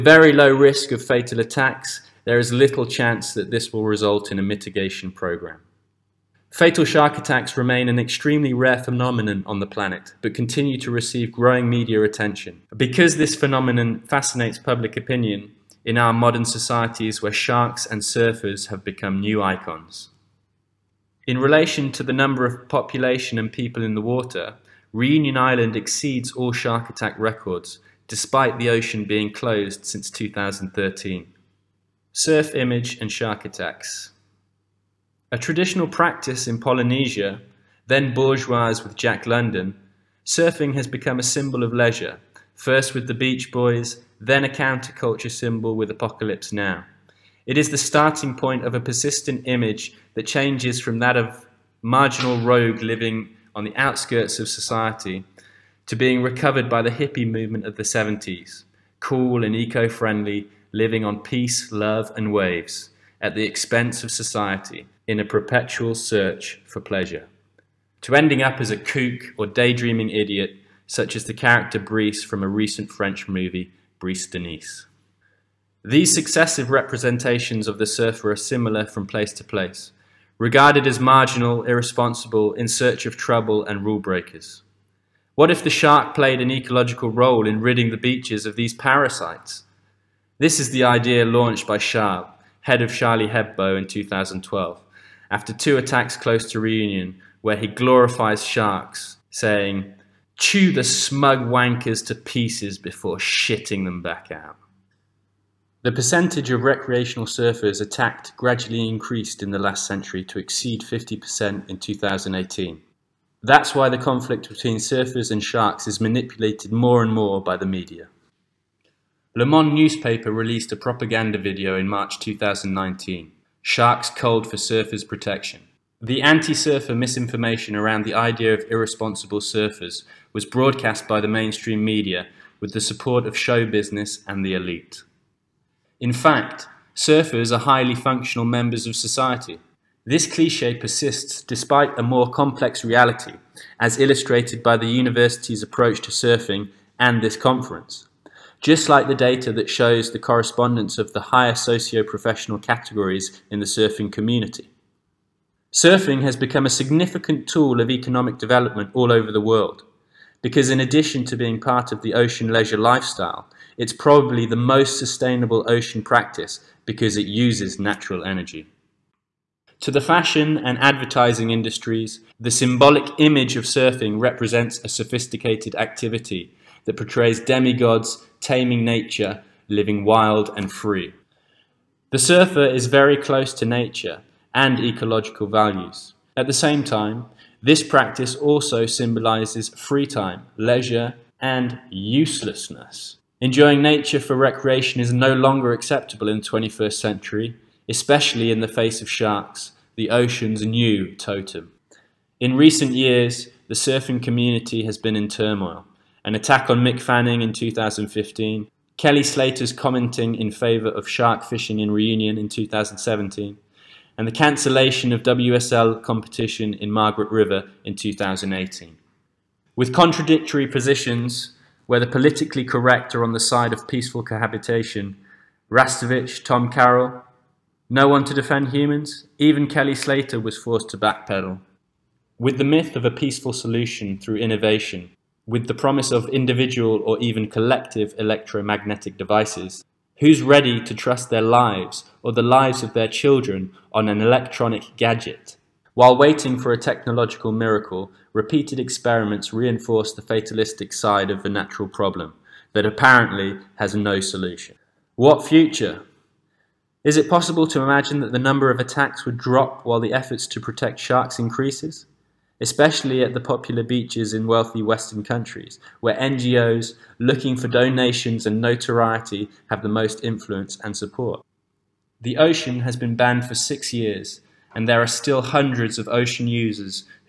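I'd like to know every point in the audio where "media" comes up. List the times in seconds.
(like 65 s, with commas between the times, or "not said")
11 s, 117 s, 131 s.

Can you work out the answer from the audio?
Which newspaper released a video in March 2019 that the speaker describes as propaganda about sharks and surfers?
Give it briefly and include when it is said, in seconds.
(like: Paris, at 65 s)
Le Monde, at 119 s.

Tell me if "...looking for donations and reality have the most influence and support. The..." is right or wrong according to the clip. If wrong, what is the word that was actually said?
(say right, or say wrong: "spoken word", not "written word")
wrong: "notoriety", not "reality".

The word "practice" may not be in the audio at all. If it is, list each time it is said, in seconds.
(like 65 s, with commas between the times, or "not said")
35 s, 166 s, 187 s.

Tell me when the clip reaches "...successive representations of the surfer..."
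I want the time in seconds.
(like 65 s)
76 s.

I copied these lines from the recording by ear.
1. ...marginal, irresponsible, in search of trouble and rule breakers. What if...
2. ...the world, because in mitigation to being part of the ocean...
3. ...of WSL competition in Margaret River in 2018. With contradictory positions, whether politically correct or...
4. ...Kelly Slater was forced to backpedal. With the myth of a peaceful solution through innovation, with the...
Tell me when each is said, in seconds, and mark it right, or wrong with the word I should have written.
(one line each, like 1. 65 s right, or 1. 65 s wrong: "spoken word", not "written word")
1. 80 s right
2. 159 s wrong: "addition", not "mitigation"
3. 215 s right
4. 229 s right.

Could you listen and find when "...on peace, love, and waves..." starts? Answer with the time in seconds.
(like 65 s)
61 s.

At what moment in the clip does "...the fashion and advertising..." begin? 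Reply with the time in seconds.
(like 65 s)
169 s.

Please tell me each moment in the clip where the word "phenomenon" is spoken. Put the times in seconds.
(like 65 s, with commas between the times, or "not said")
8 s, 13 s.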